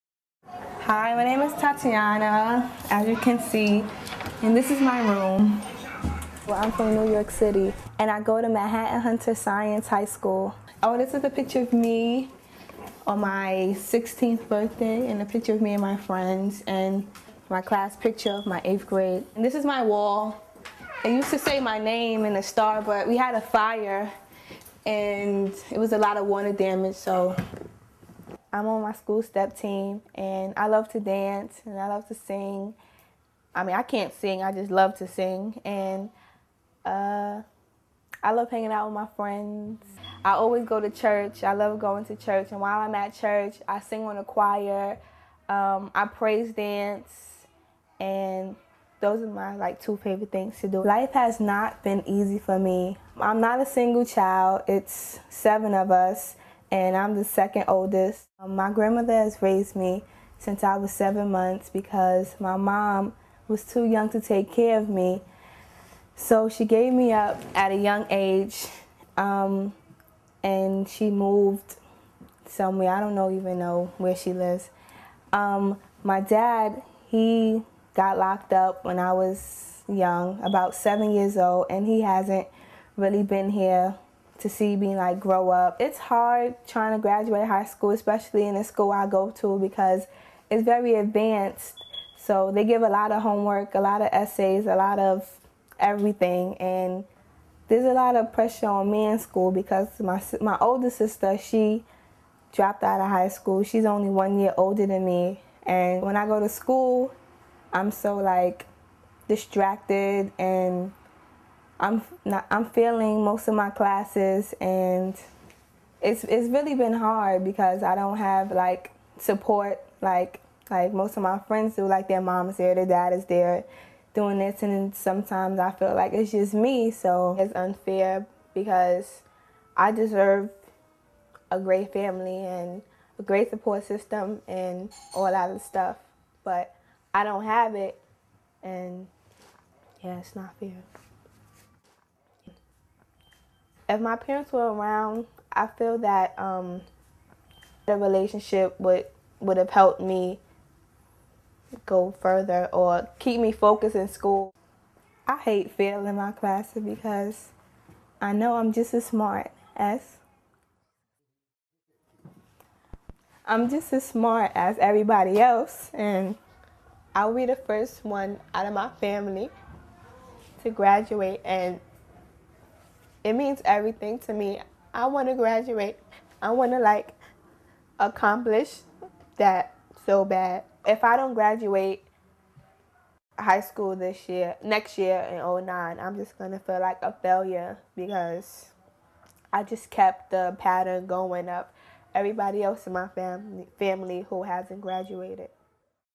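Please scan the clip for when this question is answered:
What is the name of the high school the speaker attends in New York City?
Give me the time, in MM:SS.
00:08.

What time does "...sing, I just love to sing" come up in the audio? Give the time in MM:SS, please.
00:34.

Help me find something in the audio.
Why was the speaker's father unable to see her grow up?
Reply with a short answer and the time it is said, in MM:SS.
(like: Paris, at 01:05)
He got locked up, at 01:18.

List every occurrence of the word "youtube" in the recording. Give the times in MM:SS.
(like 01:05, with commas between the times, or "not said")
not said.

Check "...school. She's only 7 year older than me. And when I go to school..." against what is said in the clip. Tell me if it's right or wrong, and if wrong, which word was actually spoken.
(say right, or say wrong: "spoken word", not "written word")
wrong: "1", not "7".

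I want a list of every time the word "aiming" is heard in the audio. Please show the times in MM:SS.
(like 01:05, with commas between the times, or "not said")
not said.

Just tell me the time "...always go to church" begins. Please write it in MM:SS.
00:40.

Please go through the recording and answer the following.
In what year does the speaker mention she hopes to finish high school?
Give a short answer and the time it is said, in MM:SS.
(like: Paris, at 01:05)
2009, at 03:05.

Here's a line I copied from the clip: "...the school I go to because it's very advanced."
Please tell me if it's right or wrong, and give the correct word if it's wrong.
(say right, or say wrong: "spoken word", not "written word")
right.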